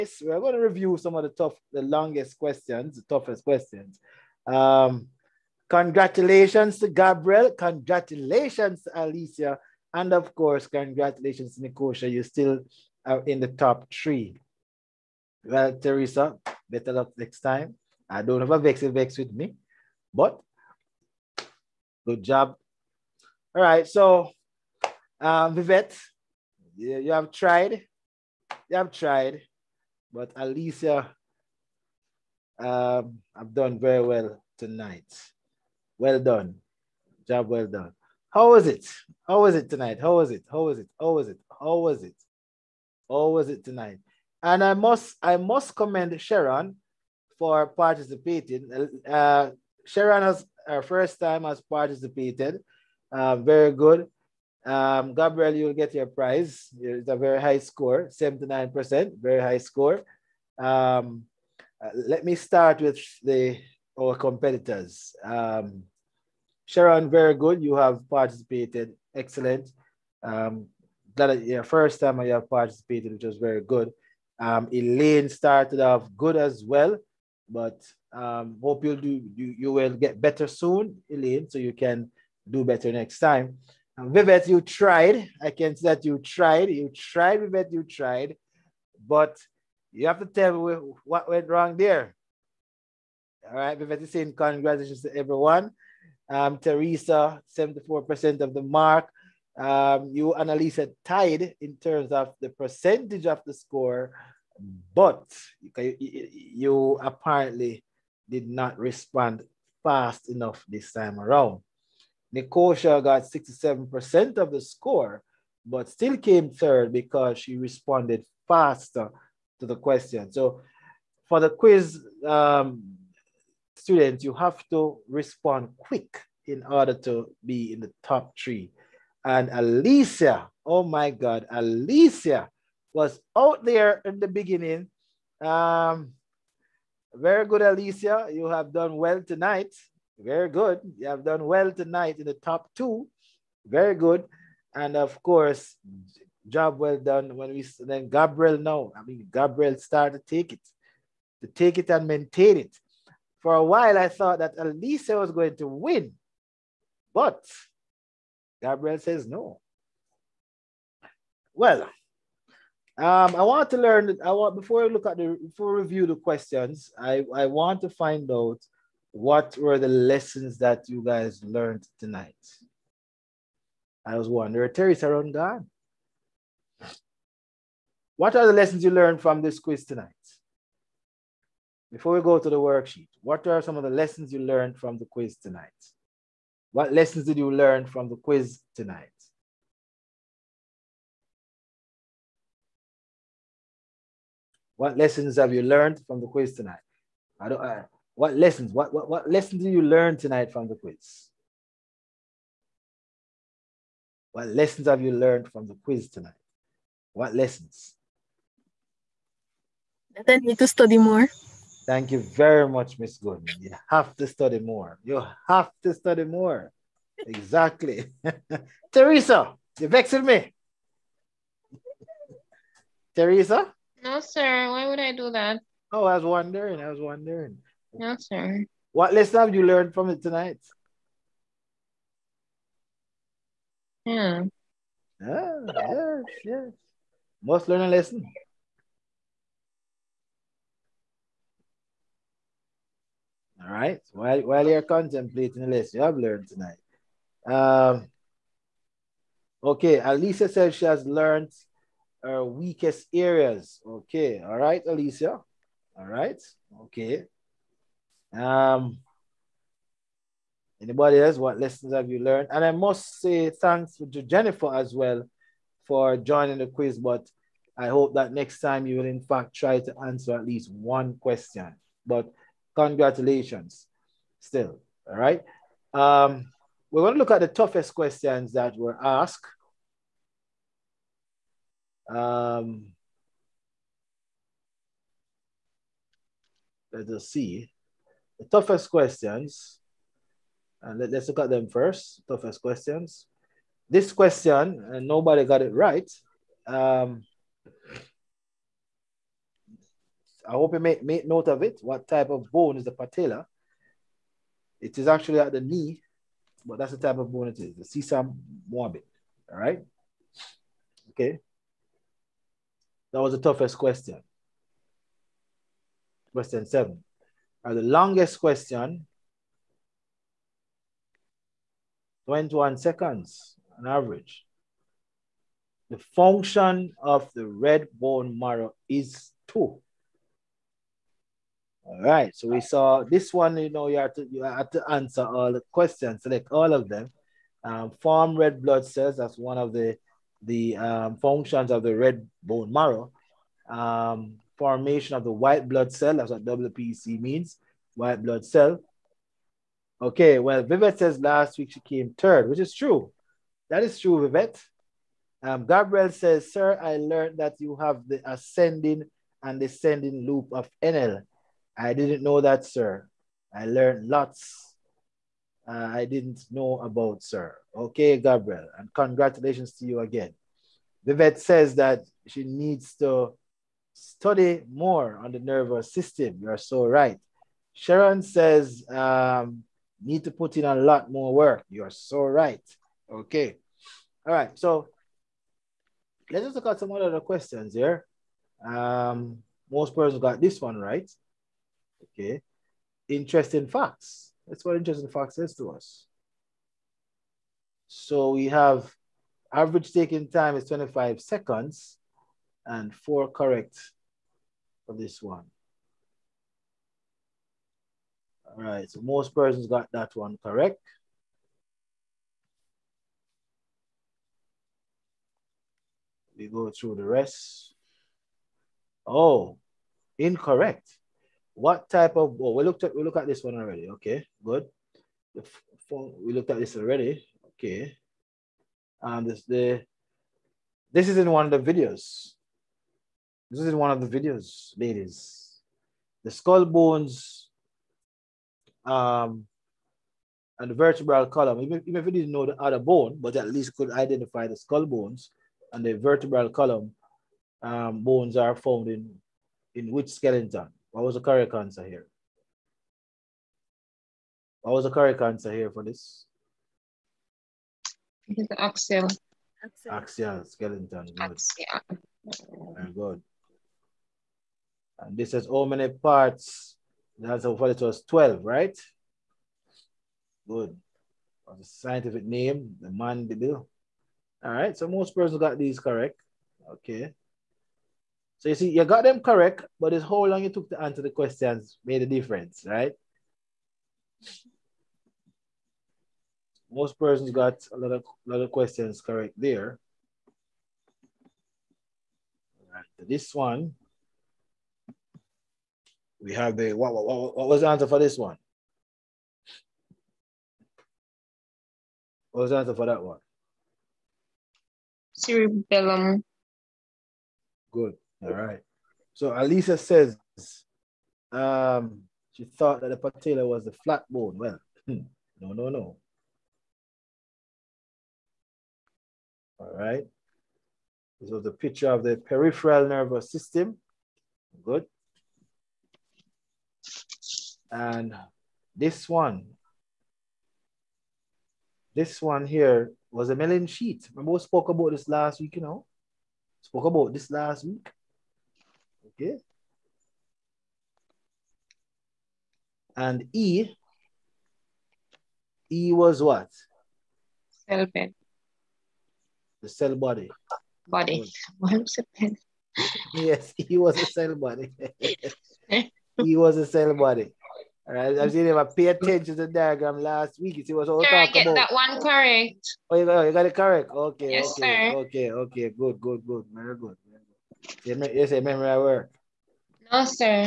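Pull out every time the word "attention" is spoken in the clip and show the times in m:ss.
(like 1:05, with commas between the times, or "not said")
9:18.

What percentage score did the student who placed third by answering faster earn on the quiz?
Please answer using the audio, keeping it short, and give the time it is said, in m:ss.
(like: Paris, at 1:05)
67%, at 1:53.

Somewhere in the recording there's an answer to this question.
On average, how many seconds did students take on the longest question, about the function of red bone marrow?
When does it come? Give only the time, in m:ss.
5:22.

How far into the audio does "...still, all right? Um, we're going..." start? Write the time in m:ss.
4:34.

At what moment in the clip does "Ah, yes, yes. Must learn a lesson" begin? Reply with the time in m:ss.
3:55.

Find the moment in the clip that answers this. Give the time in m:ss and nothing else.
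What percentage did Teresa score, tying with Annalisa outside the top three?
1:37.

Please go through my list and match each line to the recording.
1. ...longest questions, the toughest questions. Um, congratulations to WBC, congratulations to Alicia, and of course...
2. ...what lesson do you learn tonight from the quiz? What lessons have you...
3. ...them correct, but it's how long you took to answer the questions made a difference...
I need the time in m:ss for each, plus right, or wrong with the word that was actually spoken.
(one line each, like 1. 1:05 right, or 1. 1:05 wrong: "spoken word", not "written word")
1. 0:01 wrong: "Gabriel", not "WBC"
2. 3:19 right
3. 7:59 right.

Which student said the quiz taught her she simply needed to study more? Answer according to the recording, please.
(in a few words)
Miss Goodman.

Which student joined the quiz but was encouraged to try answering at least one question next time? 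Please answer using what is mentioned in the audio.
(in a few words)
Jennifer.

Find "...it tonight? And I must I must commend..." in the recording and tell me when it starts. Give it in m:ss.
0:43.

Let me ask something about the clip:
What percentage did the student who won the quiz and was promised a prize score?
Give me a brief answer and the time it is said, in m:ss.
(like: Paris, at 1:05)
79%, at 0:58.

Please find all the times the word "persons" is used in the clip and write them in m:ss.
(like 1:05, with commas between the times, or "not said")
6:29, 6:49, 7:55, 8:06.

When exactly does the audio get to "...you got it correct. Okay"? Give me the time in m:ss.
9:23.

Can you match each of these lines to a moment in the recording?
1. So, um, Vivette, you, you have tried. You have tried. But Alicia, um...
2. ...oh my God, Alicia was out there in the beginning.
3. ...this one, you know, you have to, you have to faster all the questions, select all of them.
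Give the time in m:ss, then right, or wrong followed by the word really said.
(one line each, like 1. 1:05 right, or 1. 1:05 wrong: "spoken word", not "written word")
1. 0:23 right
2. 2:10 right
3. 5:33 wrong: "answer", not "faster".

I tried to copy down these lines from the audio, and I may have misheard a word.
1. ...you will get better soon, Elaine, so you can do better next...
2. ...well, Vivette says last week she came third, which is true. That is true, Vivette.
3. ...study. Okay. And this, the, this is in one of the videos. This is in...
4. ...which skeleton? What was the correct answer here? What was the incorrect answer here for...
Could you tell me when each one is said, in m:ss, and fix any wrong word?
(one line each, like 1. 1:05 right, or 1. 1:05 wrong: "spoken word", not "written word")
1. 1:19 right
2. 5:50 right
3. 7:06 wrong: "already", not "study"
4. 7:29 wrong: "correct", not "incorrect".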